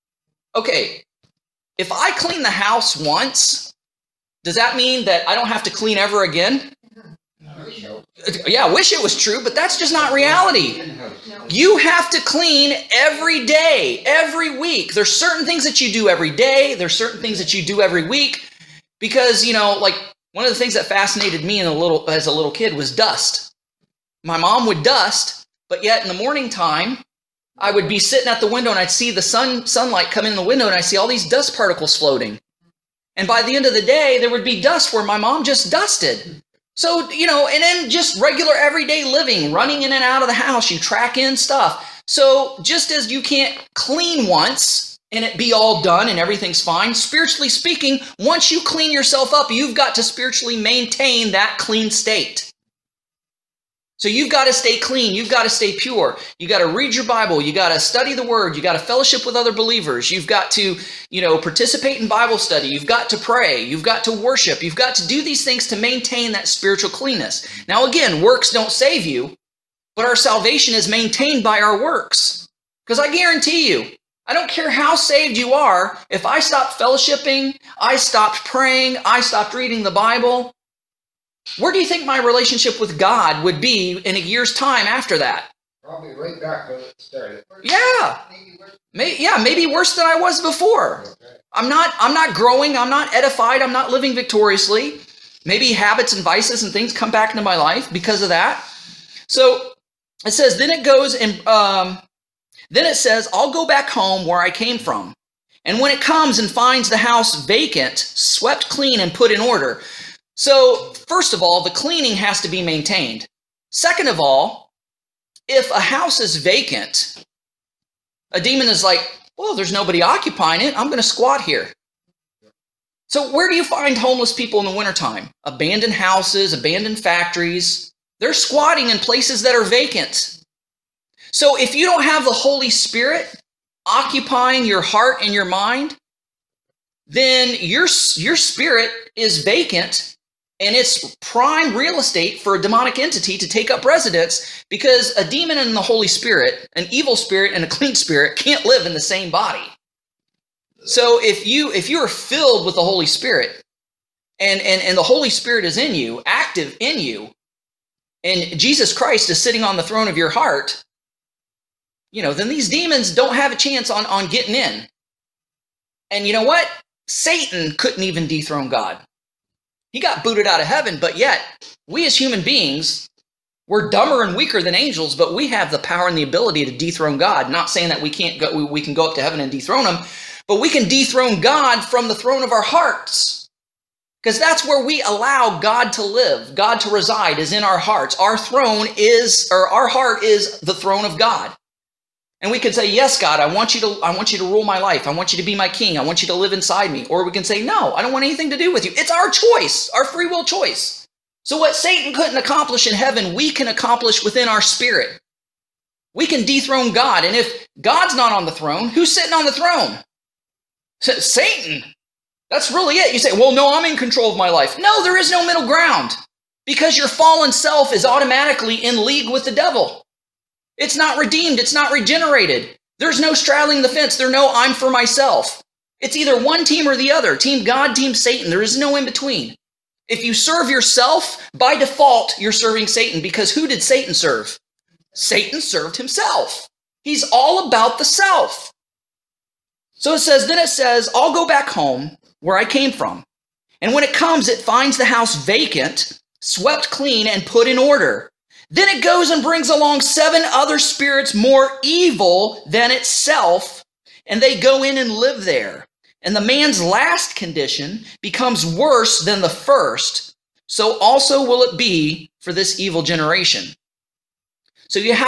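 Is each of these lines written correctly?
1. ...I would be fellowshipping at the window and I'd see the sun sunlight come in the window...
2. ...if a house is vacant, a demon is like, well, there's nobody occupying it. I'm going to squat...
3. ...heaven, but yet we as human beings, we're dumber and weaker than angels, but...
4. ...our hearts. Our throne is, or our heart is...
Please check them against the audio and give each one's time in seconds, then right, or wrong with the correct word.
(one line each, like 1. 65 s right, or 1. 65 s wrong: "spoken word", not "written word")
1. 27 s wrong: "sitting", not "fellowshipping"
2. 115 s right
3. 170 s right
4. 187 s right.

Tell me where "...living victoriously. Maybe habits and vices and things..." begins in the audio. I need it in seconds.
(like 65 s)
93 s.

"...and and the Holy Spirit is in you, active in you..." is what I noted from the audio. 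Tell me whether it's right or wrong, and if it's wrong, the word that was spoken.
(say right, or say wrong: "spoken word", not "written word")
right.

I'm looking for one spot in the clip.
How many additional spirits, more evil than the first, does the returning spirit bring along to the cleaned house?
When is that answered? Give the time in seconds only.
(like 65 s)
250 s.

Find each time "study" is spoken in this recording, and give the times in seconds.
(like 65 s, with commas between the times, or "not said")
57 s, 62 s.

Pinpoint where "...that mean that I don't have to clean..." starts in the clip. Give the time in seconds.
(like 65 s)
4 s.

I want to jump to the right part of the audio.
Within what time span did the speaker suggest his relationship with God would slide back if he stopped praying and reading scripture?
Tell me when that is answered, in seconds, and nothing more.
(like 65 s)
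84 s.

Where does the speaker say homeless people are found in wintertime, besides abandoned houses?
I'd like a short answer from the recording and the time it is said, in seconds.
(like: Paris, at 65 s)
Abandoned factories, at 126 s.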